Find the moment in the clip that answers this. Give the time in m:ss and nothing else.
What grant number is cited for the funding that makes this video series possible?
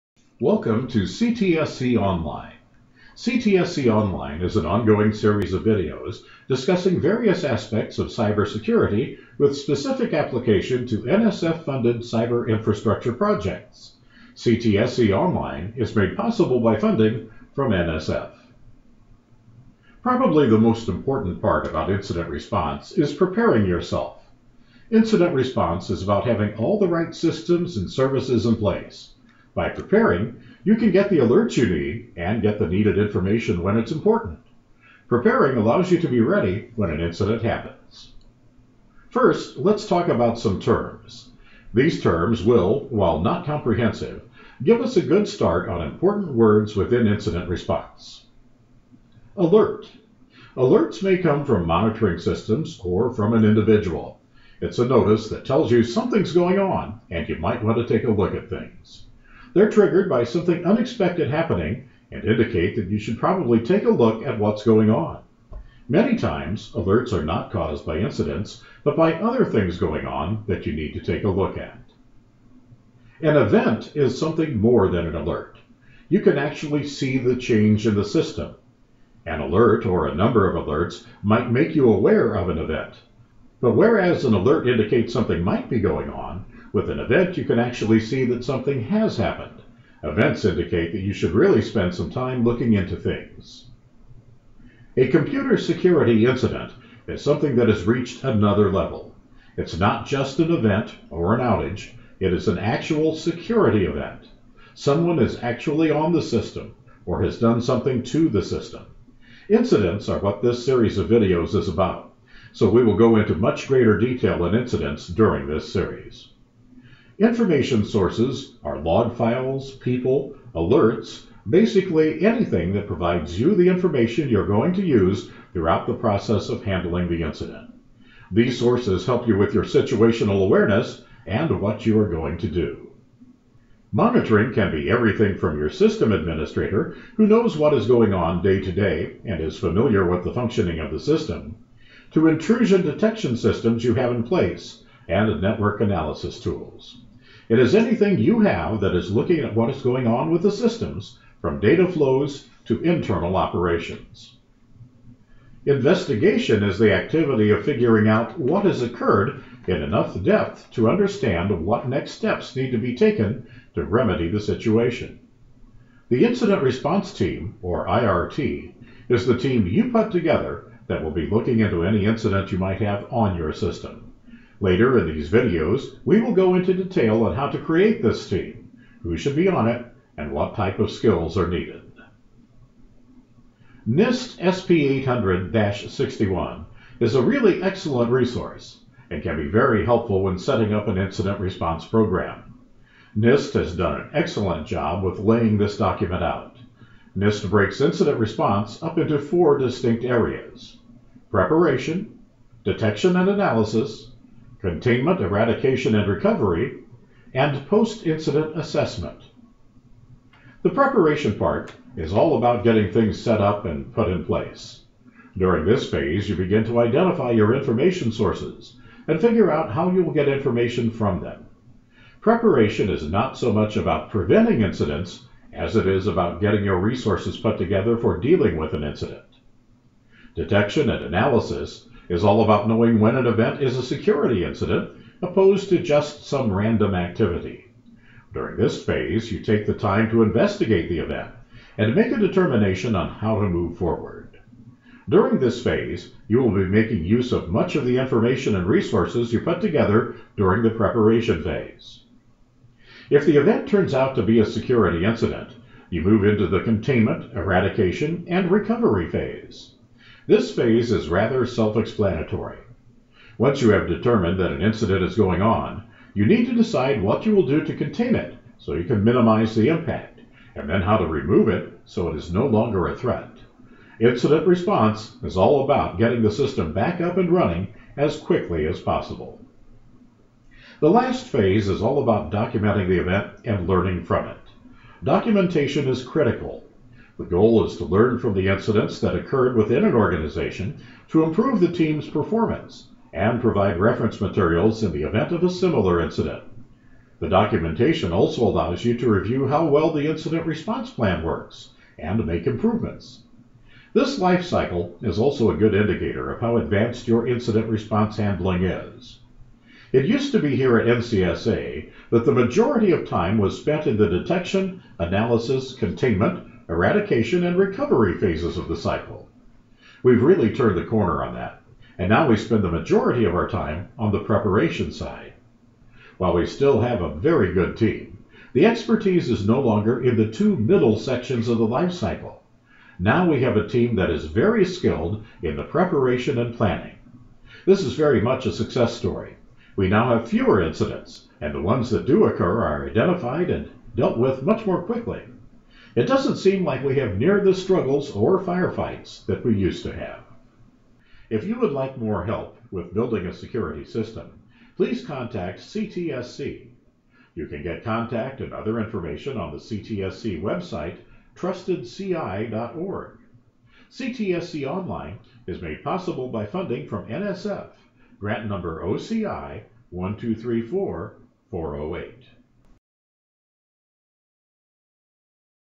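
6:08.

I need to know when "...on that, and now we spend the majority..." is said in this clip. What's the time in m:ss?
5:21.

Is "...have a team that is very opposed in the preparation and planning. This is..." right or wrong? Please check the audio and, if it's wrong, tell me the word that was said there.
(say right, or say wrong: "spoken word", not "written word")
wrong: "skilled", not "opposed".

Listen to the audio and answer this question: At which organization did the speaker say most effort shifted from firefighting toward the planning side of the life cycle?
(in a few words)
NCSA.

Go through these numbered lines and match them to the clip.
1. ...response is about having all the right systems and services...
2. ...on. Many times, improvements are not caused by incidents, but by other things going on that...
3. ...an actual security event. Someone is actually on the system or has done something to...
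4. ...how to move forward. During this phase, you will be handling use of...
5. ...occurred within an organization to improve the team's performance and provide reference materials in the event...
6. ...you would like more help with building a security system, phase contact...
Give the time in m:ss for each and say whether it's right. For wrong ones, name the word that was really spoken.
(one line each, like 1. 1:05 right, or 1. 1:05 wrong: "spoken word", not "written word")
1. 0:25 right
2. 1:04 wrong: "alerts", not "improvements"
3. 1:42 right
4. 4:03 wrong: "making", not "handling"
5. 4:49 right
6. 5:51 wrong: "please", not "phase".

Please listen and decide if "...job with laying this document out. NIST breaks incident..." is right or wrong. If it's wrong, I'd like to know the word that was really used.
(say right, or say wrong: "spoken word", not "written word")
right.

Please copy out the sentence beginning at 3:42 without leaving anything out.
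Preparation is not so much about preventing incidents as it is about getting your resources put together for dealing with an incident.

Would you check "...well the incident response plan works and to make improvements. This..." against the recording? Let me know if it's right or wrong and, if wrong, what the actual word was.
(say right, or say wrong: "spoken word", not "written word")
right.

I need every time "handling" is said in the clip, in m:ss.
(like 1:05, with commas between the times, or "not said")
2:06, 5:08.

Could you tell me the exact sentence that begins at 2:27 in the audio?
It is anything you have that is looking at what is going on with the systems, from data flows to internal operations.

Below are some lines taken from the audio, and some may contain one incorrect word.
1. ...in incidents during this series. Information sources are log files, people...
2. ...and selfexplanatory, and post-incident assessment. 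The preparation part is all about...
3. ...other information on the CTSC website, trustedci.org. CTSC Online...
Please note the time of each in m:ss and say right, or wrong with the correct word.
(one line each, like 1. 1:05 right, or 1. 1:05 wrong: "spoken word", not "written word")
1. 1:54 right
2. 3:25 wrong: "recovery", not "selfexplanatory"
3. 5:58 right.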